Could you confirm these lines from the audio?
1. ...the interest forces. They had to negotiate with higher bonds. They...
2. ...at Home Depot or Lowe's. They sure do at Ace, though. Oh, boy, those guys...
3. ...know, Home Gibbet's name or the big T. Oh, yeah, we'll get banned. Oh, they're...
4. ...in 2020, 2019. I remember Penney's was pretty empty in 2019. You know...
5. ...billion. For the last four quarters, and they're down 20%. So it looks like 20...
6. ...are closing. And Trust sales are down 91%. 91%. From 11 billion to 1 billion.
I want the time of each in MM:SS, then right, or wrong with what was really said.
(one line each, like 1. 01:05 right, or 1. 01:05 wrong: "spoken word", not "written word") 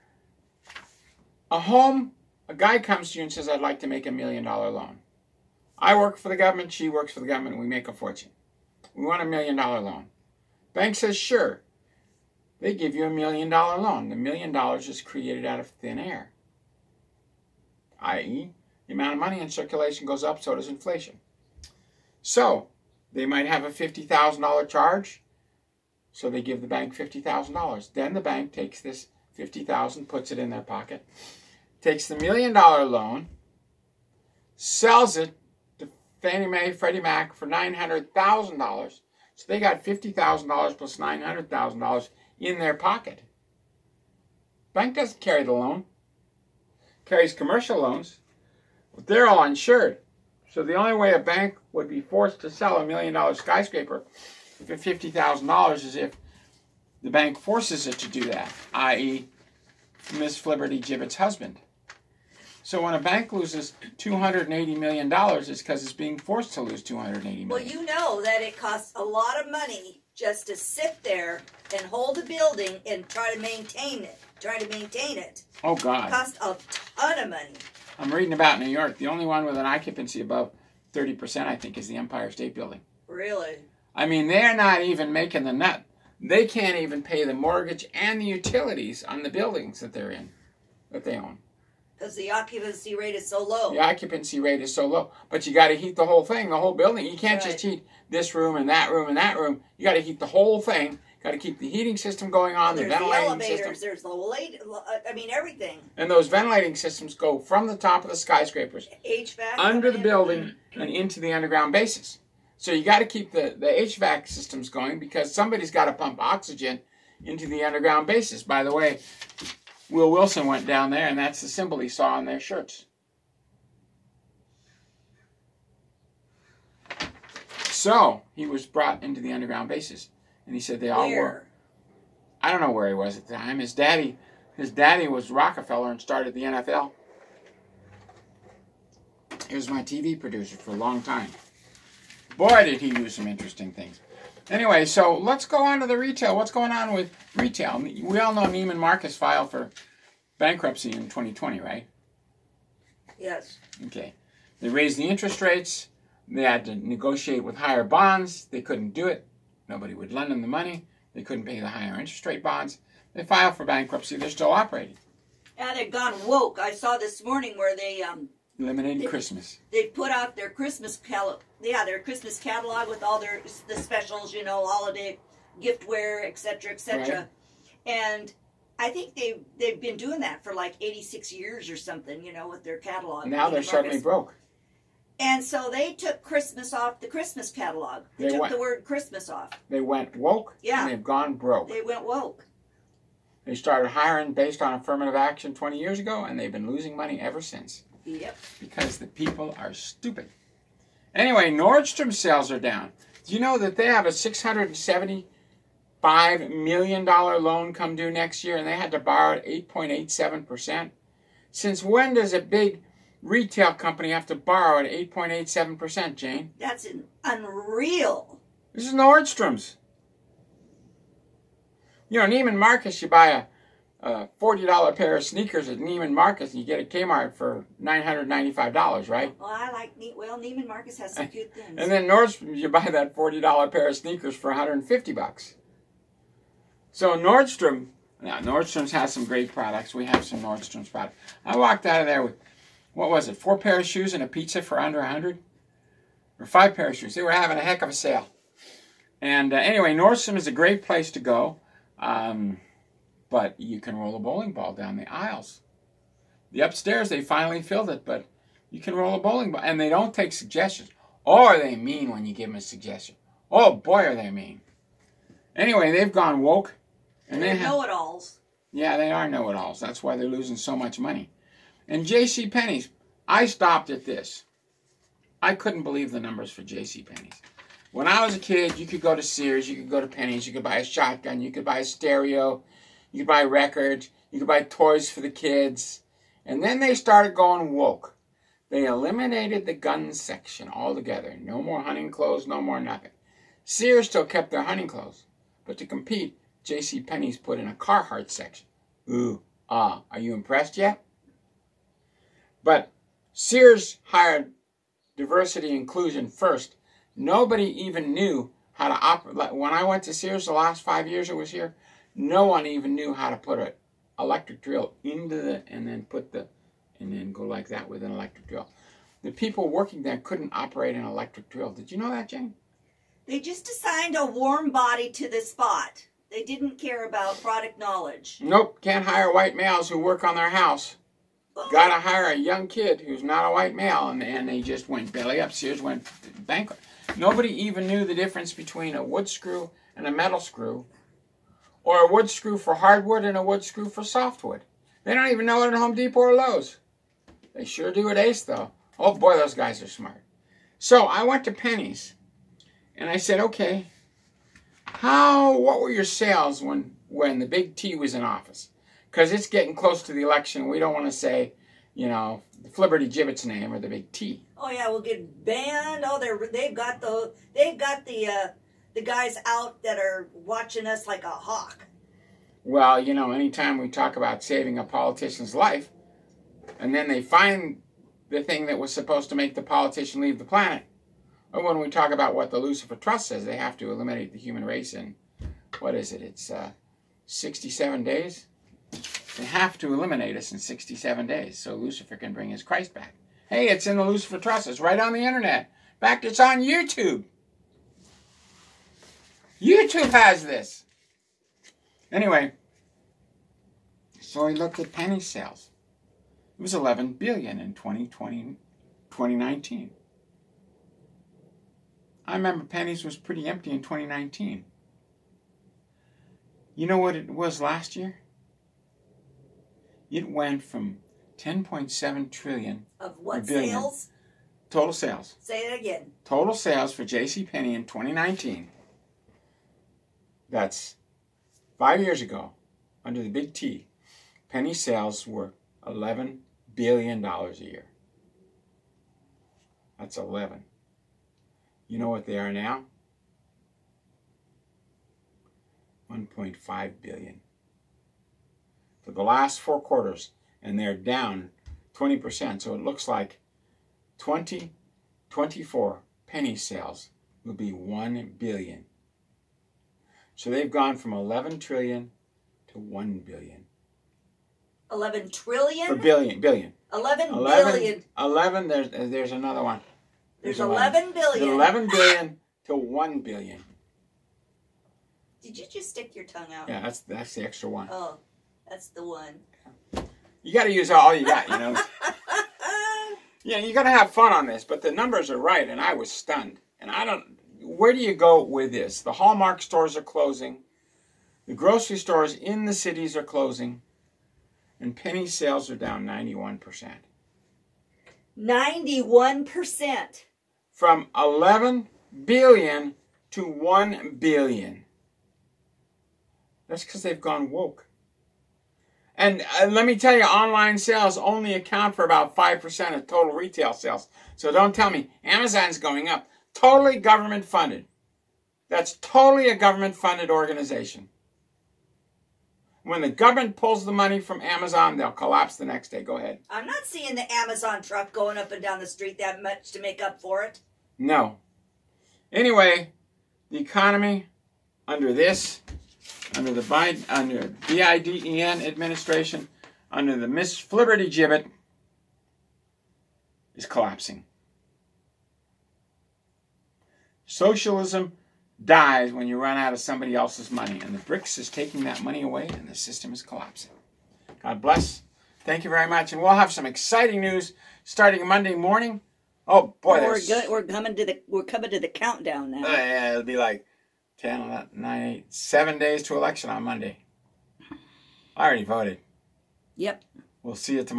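1. 02:34 wrong: "rates", not "forces"
2. 05:45 right
3. 06:02 wrong: "Flibberty", not "Home"
4. 06:47 right
5. 07:27 right
6. 08:13 wrong: "Penney", not "Trust".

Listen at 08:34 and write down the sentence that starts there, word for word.
So don't tell me Amazon's going up totally government funded.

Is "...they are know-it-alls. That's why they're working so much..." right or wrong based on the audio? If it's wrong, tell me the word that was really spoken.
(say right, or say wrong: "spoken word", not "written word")
wrong: "losing", not "working".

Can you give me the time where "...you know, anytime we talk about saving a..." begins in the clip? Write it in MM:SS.
06:12.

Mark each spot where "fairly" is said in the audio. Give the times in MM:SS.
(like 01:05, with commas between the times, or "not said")
not said.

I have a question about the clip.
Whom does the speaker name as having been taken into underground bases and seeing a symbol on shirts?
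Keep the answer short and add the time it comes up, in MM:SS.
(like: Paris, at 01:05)
Will Wilson, at 01:59.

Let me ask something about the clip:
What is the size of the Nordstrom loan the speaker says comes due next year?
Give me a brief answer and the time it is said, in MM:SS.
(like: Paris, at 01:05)
$675 million, at 03:24.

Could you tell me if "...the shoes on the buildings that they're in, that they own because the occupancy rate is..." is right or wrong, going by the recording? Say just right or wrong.
wrong.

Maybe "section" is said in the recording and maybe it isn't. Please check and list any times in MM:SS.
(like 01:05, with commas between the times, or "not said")
04:50, 04:58.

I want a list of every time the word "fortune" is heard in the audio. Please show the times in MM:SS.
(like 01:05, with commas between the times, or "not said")
00:07.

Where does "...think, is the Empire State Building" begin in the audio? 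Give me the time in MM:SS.
01:21.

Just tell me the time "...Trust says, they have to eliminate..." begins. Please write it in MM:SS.
06:22.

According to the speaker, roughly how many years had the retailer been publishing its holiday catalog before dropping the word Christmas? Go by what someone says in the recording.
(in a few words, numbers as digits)
86 years.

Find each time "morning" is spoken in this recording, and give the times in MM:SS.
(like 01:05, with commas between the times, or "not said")
02:47, 09:18.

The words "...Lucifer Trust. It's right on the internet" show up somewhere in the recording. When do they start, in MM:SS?
06:34.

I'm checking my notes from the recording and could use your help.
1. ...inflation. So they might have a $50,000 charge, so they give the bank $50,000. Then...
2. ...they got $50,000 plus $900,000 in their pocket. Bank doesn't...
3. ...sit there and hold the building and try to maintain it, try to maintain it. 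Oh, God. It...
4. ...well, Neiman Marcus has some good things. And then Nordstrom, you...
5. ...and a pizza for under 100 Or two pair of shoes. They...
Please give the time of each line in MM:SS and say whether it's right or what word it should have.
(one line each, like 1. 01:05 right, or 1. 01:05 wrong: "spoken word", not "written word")
1. 00:20 right
2. 00:39 right
3. 01:10 right
4. 03:50 right
5. 04:04 wrong: "five", not "two".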